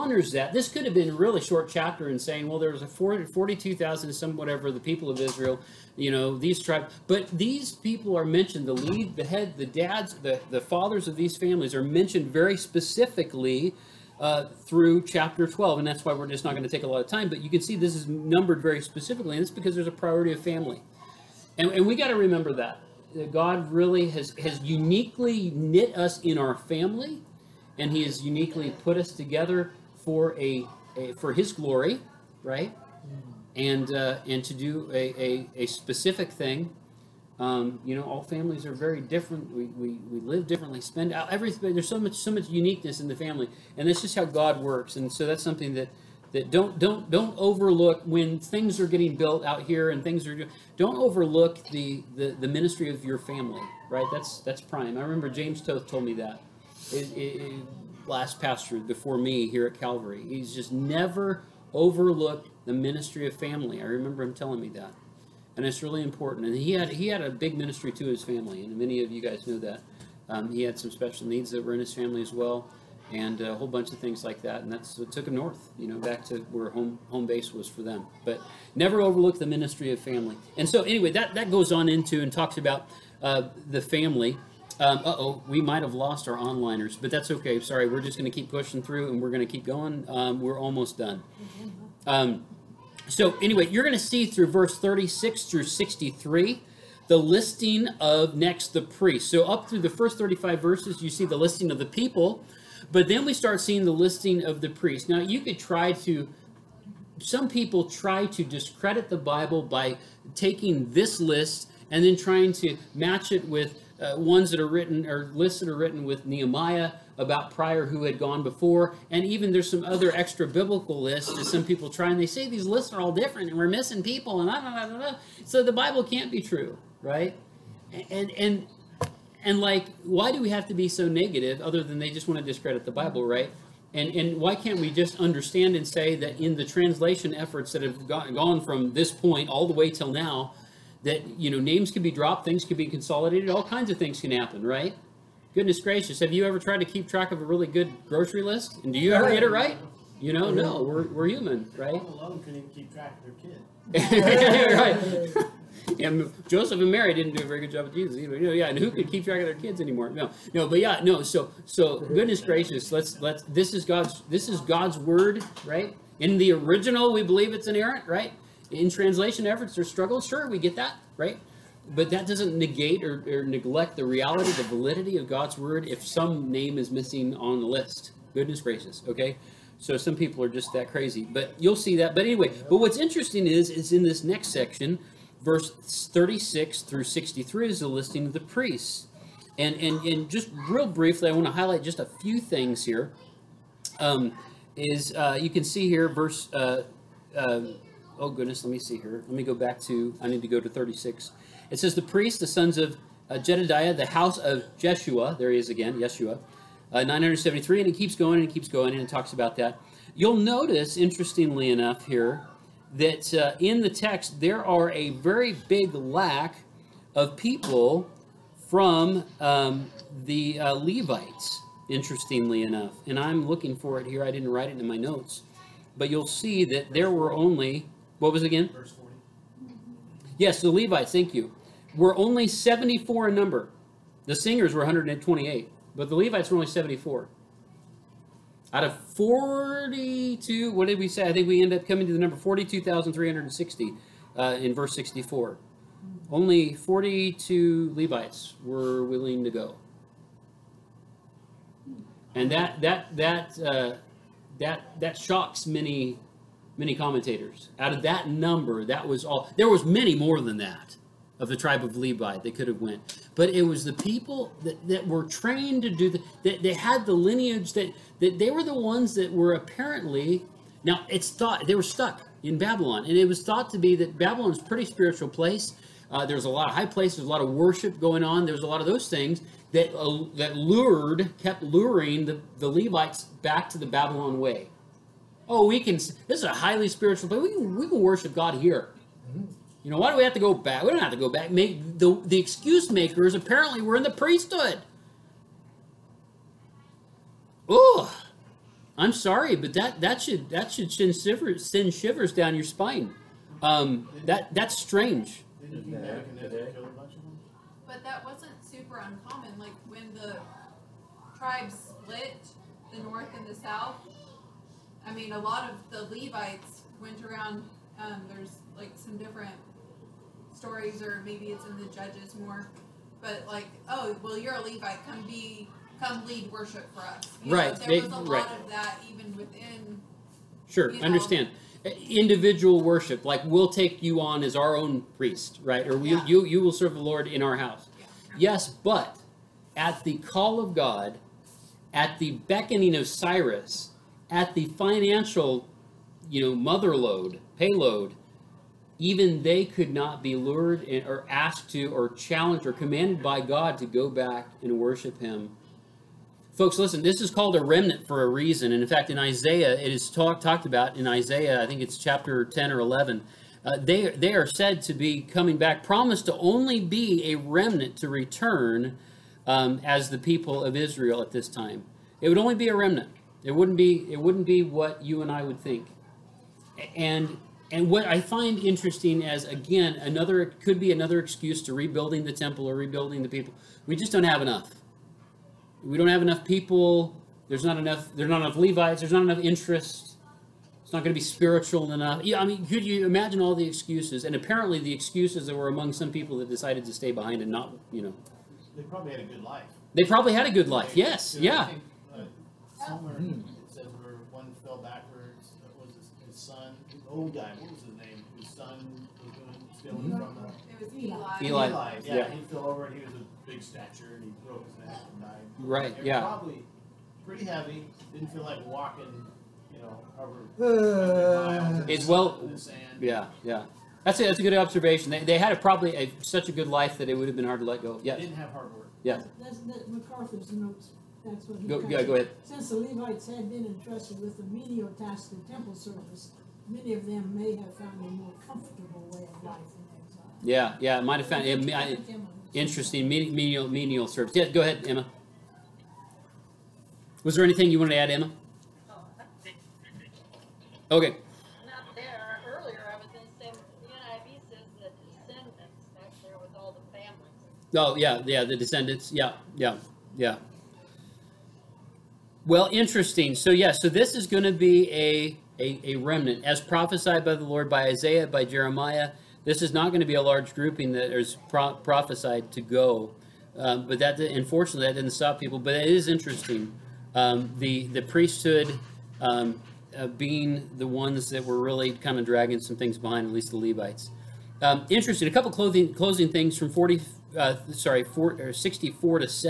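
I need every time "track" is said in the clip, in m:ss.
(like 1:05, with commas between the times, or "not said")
2:27, 2:32, 2:39.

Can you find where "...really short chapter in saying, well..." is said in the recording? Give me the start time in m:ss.
0:01.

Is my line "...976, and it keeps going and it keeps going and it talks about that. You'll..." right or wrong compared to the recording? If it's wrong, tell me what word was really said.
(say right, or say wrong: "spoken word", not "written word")
wrong: "973", not "976".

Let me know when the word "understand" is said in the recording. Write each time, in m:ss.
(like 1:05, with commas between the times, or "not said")
2:15, 5:31.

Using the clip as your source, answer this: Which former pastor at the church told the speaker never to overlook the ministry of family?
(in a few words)
James Toth.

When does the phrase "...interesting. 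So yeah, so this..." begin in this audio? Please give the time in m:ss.
7:42.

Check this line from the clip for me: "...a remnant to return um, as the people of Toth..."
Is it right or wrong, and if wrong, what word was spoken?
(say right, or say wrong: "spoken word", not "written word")
wrong: "Israel", not "Toth".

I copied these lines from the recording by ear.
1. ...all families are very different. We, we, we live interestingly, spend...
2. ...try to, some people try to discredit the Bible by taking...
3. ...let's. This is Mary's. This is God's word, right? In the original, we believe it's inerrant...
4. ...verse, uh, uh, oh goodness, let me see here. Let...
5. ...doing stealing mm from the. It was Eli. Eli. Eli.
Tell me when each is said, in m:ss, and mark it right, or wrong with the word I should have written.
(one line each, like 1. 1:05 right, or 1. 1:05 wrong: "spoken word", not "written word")
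1. 0:38 wrong: "differently", not "interestingly"
2. 1:45 right
3. 2:43 wrong: "God", not "Mary"
4. 3:16 right
5. 6:49 right.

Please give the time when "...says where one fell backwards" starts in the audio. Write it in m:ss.
6:43.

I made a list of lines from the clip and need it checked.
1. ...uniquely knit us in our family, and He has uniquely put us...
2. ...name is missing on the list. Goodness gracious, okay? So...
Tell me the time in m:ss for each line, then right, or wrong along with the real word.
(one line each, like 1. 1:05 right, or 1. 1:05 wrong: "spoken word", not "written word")
1. 0:24 right
2. 2:56 right.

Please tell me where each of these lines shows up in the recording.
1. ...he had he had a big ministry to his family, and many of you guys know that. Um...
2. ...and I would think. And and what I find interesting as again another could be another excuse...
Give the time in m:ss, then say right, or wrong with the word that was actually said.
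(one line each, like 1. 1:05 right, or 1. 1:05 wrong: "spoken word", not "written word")
1. 1:06 right
2. 6:15 right.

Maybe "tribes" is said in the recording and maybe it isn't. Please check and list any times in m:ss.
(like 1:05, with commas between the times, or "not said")
0:06, 4:21, 5:11.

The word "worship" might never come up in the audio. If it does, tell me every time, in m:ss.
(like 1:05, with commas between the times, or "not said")
4:37, 4:48, 5:26, 5:32, 5:54.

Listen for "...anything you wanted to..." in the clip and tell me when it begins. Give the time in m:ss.
7:27.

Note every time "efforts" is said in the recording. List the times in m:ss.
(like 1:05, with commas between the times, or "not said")
2:17, 2:49.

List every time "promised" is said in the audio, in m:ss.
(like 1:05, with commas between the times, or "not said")
6:05.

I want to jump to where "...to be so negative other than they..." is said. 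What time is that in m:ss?
2:10.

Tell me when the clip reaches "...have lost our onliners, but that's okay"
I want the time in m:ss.
1:25.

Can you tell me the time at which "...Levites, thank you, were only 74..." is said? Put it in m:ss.
3:50.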